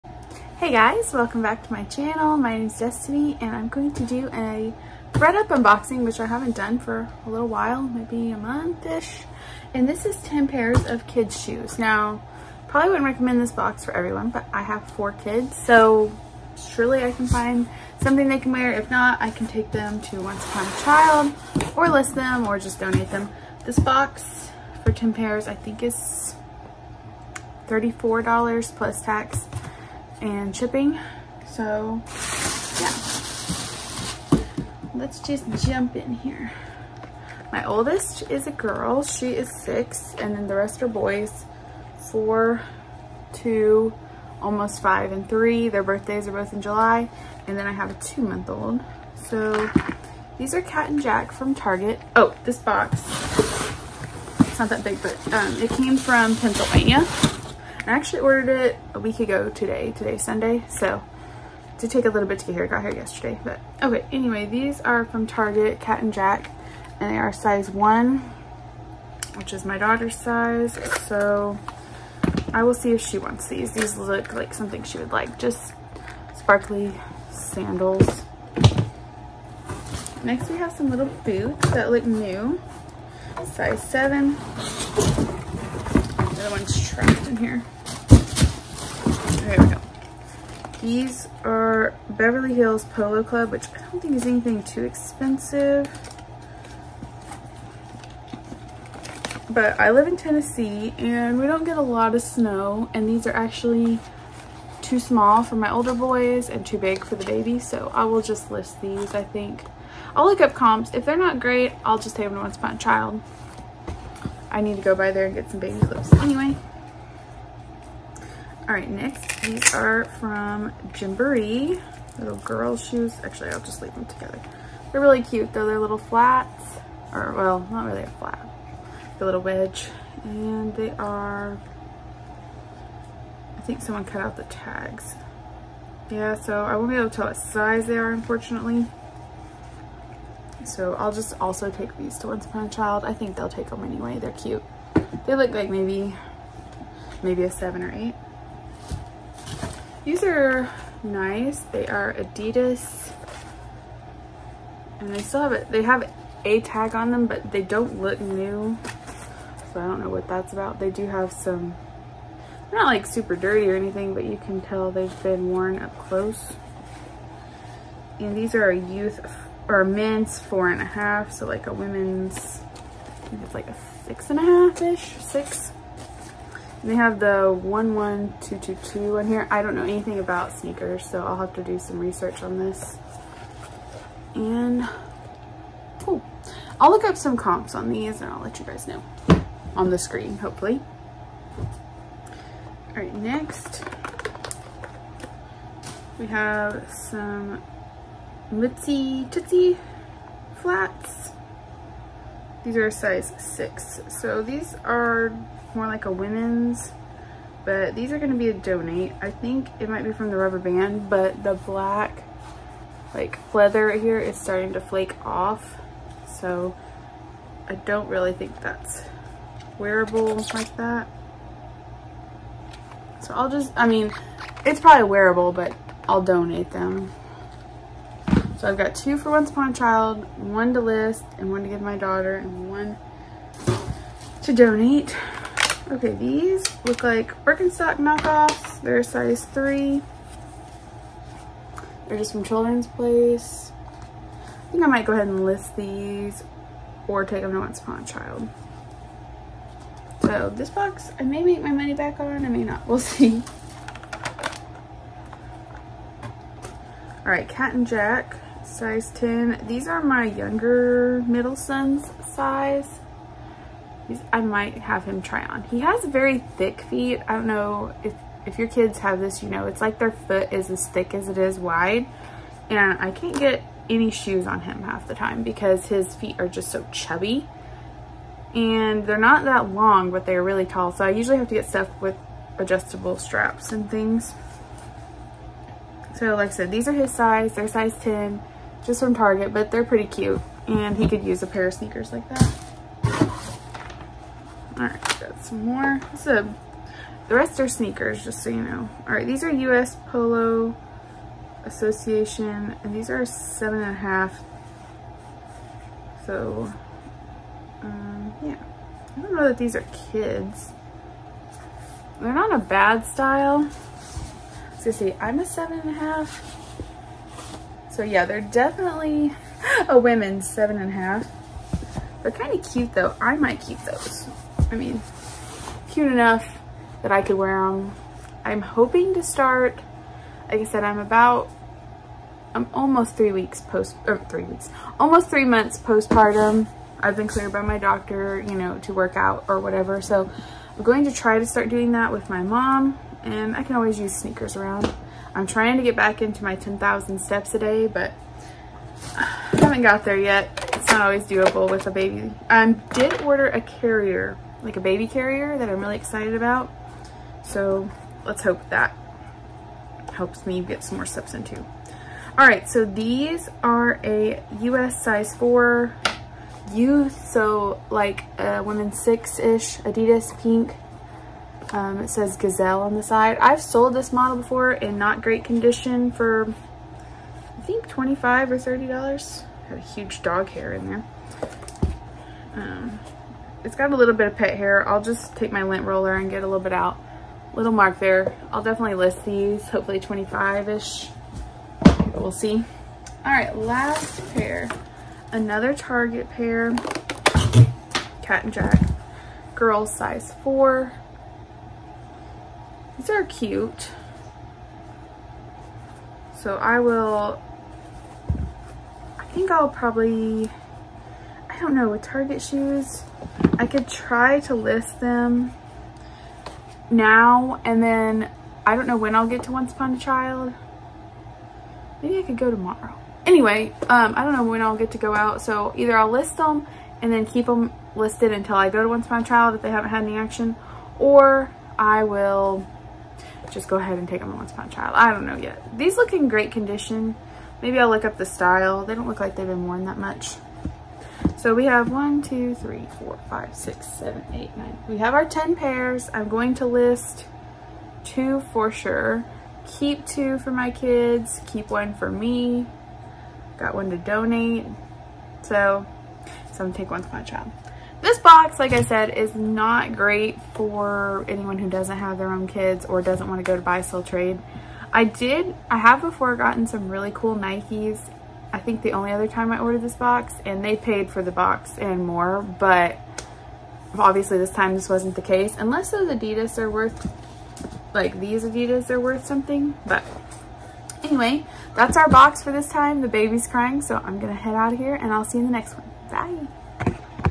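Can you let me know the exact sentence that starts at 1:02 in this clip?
I got here yesterday, but okay.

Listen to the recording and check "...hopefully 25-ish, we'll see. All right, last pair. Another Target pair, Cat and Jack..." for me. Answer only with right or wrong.
right.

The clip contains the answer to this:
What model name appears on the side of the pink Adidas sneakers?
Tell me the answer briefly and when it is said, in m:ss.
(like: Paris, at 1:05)
Gazelle, at 6:12.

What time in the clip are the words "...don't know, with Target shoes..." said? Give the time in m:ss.
6:51.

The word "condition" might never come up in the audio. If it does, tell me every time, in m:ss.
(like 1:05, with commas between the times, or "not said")
6:15, 7:16.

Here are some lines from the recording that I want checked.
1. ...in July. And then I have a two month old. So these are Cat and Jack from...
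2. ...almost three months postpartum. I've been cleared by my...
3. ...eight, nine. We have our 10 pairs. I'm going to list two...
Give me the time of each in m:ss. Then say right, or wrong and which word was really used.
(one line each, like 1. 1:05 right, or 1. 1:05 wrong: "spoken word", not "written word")
1. 0:46 right
2. 5:34 right
3. 7:24 right.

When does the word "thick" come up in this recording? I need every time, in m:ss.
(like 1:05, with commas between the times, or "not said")
4:26, 4:30.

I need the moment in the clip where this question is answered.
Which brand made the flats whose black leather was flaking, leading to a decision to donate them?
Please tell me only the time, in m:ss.
3:18.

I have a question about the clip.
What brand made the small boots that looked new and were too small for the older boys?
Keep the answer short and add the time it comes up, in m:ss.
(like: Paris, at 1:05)
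Beverly Hills Polo Club, at 1:32.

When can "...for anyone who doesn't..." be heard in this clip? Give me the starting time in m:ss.
7:40.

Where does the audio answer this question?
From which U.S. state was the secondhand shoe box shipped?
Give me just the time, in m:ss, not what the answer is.
0:56.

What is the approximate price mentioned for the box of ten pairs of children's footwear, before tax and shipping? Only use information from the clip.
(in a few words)
$34.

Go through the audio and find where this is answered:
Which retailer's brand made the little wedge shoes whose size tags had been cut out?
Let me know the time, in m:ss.
2:00.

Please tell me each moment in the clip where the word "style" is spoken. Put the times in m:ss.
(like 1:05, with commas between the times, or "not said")
5:13, 7:18.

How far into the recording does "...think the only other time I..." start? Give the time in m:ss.
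7:48.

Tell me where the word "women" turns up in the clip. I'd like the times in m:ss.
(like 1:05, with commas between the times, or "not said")
2:51, 3:26, 5:19, 6:08.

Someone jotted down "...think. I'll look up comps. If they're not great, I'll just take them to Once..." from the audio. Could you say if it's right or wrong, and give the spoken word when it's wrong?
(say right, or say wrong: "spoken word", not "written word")
right.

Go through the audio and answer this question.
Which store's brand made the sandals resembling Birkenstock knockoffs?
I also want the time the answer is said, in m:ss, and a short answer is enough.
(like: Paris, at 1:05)
Children's Place, at 4:02.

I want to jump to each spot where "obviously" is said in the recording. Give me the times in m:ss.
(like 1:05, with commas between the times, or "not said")
7:53.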